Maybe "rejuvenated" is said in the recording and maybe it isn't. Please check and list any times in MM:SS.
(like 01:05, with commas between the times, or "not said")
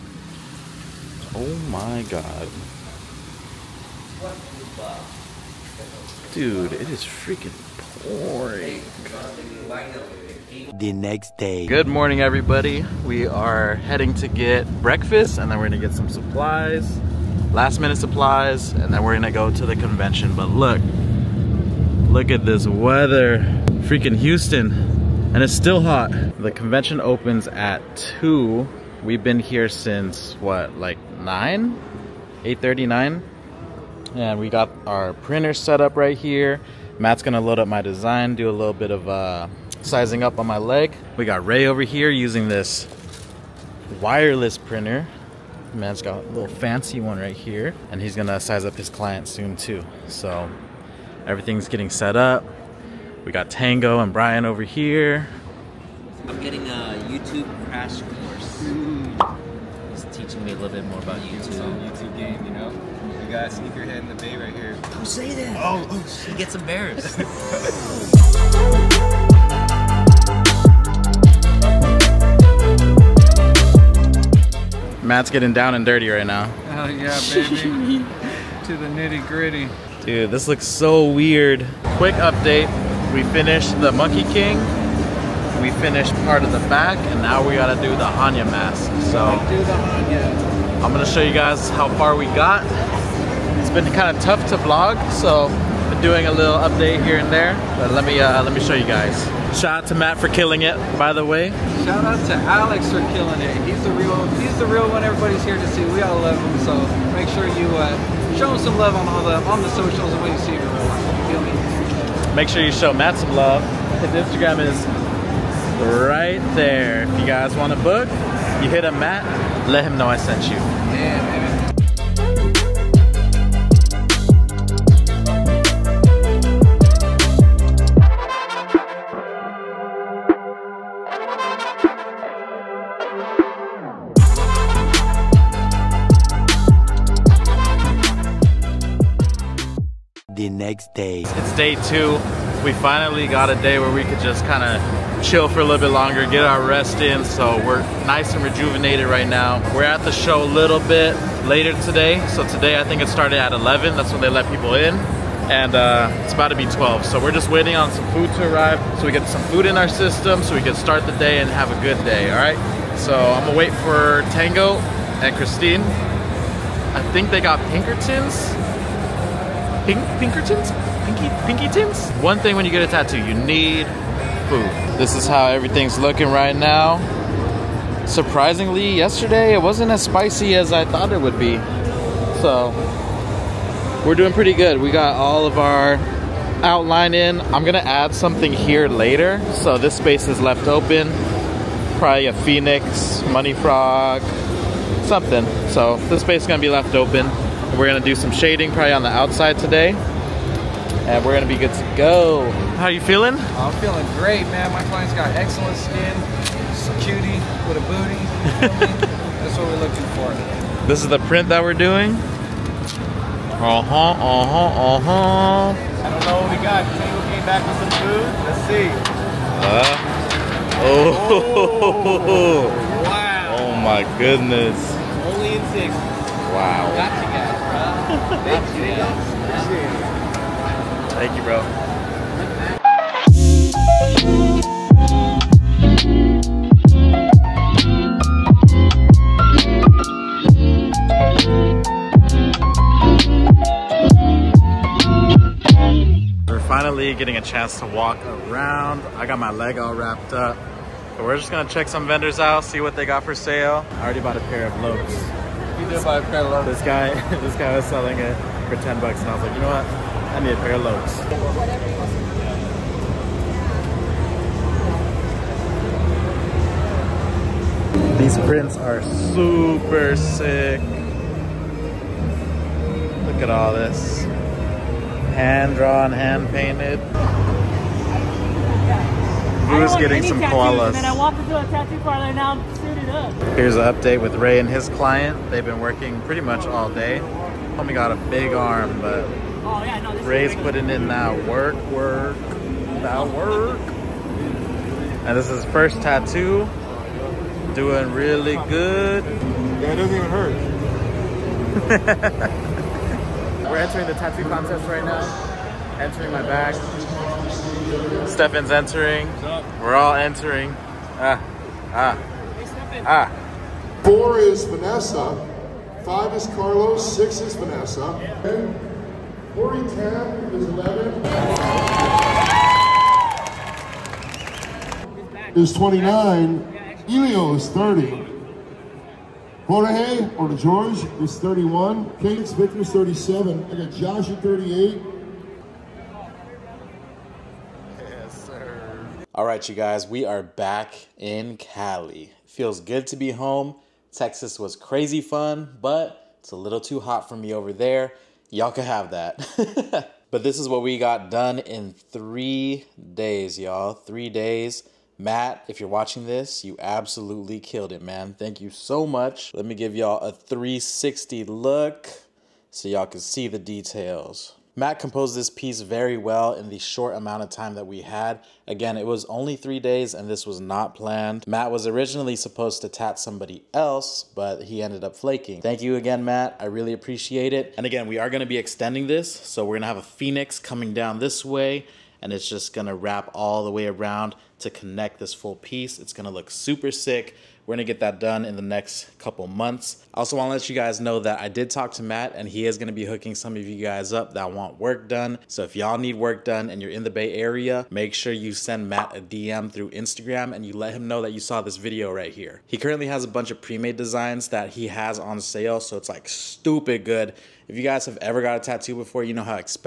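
02:28.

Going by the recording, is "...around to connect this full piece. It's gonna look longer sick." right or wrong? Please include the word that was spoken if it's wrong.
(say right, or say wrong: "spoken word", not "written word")
wrong: "super", not "longer".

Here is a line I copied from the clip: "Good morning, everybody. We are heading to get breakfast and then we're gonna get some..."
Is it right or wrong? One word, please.
right.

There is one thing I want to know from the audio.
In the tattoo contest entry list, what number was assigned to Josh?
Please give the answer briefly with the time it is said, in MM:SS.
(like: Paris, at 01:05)
38, at 05:33.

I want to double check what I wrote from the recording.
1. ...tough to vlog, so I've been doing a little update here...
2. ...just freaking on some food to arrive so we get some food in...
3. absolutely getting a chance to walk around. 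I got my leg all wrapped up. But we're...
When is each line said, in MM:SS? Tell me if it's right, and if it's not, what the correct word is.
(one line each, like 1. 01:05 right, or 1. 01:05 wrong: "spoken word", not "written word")
1. 01:34 right
2. 02:37 wrong: "waiting", not "freaking"
3. 04:06 wrong: "finally", not "absolutely".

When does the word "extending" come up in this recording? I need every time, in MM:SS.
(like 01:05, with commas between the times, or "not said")
06:18.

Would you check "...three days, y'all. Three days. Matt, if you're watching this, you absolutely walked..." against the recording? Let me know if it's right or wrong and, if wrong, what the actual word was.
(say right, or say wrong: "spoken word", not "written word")
wrong: "killed", not "walked".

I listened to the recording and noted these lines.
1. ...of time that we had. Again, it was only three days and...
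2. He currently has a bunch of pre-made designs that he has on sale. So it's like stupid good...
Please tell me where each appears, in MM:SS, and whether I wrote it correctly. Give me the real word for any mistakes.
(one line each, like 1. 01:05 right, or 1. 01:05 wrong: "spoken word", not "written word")
1. 06:07 right
2. 06:42 right.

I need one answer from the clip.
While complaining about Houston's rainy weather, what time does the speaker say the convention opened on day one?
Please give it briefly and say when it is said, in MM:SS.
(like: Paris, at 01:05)
2, at 00:26.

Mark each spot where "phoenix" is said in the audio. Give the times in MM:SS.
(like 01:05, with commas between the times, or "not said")
03:12, 06:20.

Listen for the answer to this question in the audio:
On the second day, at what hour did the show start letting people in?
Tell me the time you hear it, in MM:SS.
02:32.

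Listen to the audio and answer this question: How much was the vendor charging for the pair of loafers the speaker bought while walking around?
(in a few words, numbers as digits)
10 bucks.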